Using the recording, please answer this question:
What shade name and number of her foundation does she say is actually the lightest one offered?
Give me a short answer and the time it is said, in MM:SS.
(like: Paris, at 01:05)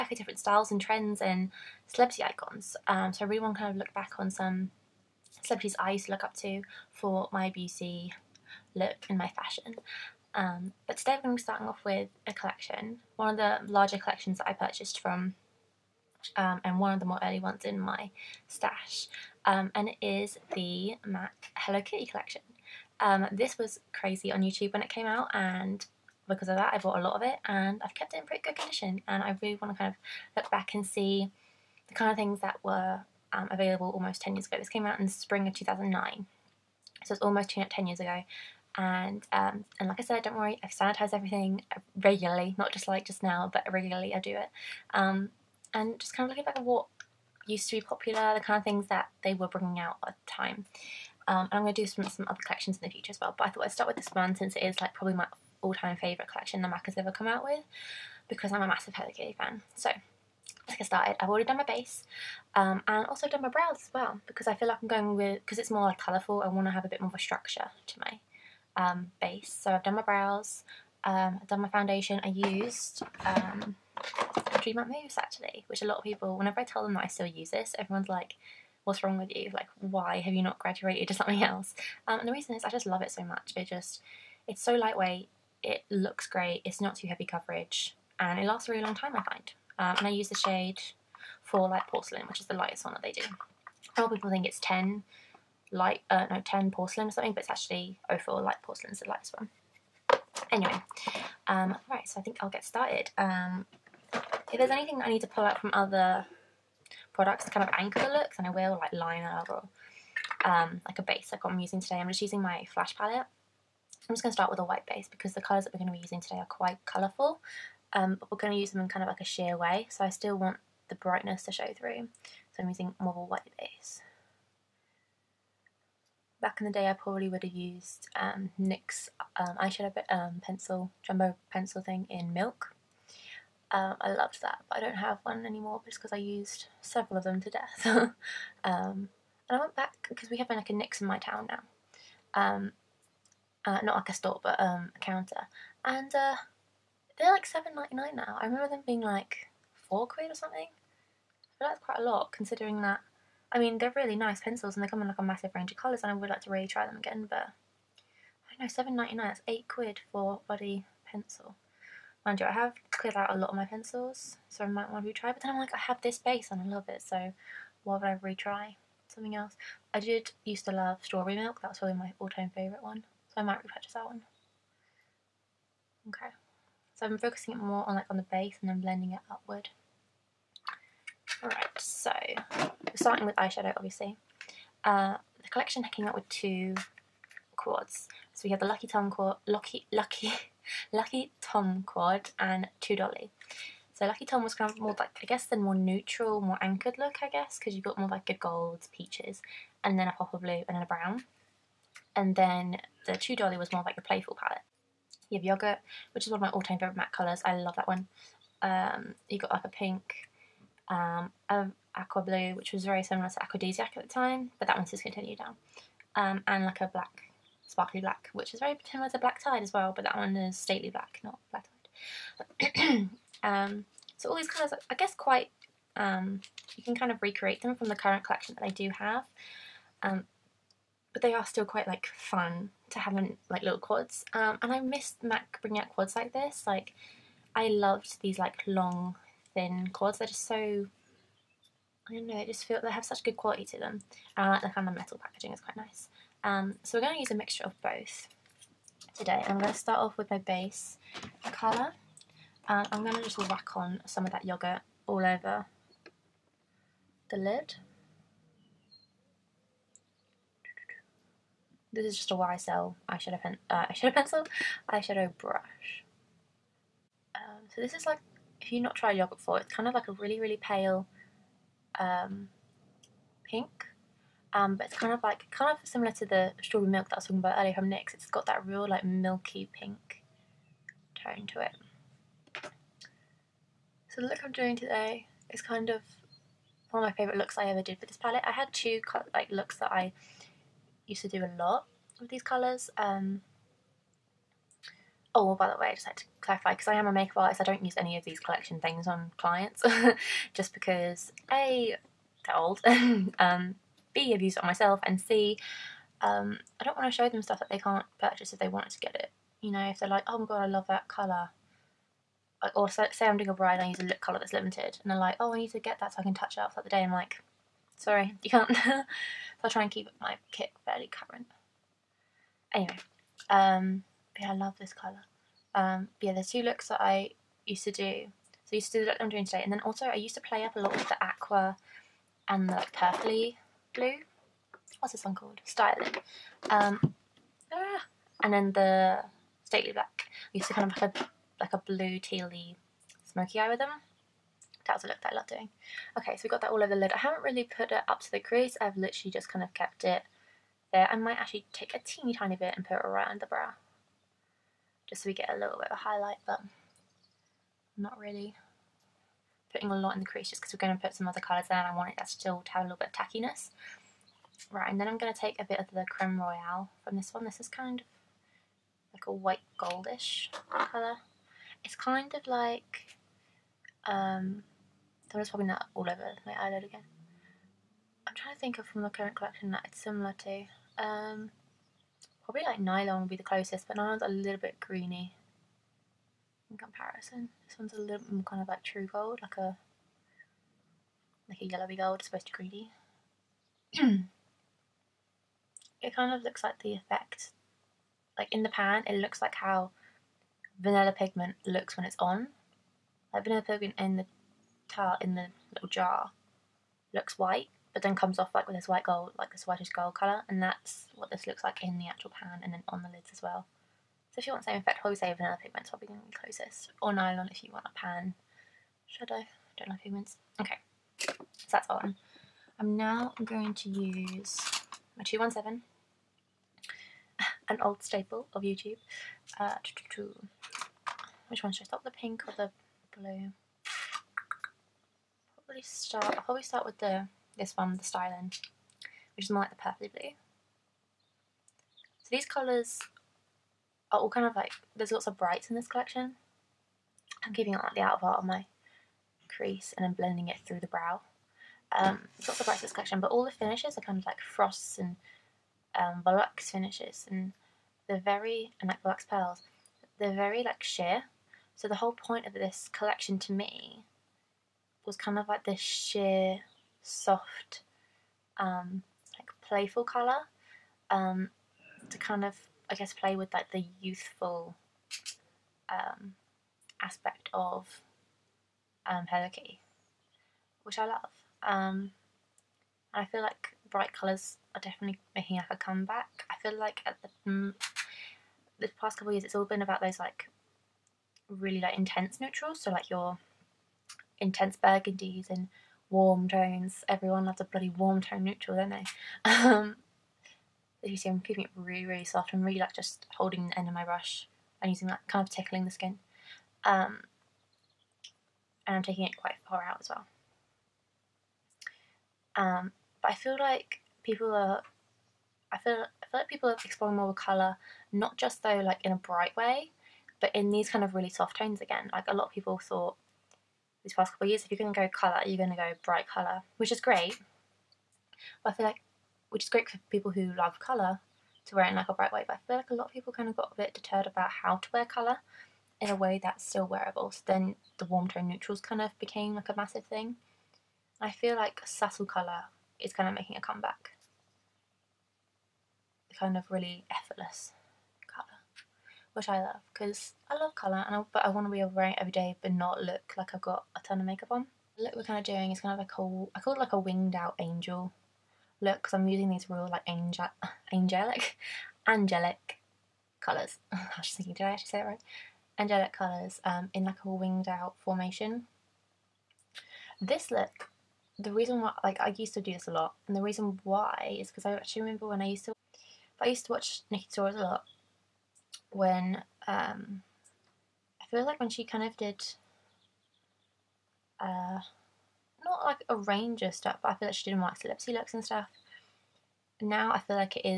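04 light porcelain, at 01:38.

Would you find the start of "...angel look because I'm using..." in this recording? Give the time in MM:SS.
09:17.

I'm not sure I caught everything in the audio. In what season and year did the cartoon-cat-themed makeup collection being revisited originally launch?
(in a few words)
spring of 2009.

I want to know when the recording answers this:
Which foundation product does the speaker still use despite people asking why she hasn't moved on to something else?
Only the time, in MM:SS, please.
01:14.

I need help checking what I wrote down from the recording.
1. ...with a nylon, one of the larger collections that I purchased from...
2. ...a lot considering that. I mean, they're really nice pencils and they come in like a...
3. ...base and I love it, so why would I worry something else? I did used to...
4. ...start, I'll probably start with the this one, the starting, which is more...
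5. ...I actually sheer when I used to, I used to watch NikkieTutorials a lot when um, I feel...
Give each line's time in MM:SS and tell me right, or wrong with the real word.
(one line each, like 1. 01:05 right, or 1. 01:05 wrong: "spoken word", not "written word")
1. 00:11 wrong: "collection", not "nylon"
2. 02:31 right
3. 02:46 wrong: "retry", not "worry"
4. 07:15 wrong: "styling", not "starting"
5. 09:34 wrong: "remember", not "sheer".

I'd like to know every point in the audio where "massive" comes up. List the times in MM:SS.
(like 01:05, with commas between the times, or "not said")
00:58, 02:35, 08:59.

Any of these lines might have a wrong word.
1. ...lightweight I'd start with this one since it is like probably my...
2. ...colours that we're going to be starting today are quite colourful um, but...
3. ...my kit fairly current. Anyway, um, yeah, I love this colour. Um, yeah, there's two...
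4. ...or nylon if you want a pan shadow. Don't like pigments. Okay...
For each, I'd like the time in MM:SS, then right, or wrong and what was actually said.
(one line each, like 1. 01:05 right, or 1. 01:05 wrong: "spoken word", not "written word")
1. 00:53 wrong: "thought", not "lightweight"
2. 01:55 wrong: "using", not "starting"
3. 05:20 right
4. 06:57 right.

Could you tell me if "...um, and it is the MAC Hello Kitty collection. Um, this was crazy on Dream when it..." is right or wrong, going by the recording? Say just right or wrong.
wrong.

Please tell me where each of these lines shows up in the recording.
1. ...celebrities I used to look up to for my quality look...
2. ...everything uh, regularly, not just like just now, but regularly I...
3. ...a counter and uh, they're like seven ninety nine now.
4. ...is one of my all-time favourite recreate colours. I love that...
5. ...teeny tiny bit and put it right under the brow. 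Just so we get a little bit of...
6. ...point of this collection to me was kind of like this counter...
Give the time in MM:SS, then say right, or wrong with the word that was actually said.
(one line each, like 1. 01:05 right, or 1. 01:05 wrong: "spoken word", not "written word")
1. 00:05 wrong: "beauty", not "quality"
2. 00:41 right
3. 02:24 right
4. 03:26 wrong: "matte", not "recreate"
5. 05:51 right
6. 07:42 wrong: "sheer", not "counter".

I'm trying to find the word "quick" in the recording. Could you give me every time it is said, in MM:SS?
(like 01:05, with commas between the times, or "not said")
not said.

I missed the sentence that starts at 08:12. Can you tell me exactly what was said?
So like your intense burgundies and warm tones.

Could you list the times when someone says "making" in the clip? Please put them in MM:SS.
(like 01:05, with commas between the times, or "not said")
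08:05, 09:03.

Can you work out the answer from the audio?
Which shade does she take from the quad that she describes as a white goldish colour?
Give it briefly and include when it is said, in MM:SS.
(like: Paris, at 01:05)
Creme Royale, at 06:06.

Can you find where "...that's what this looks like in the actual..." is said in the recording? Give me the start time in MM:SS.
06:50.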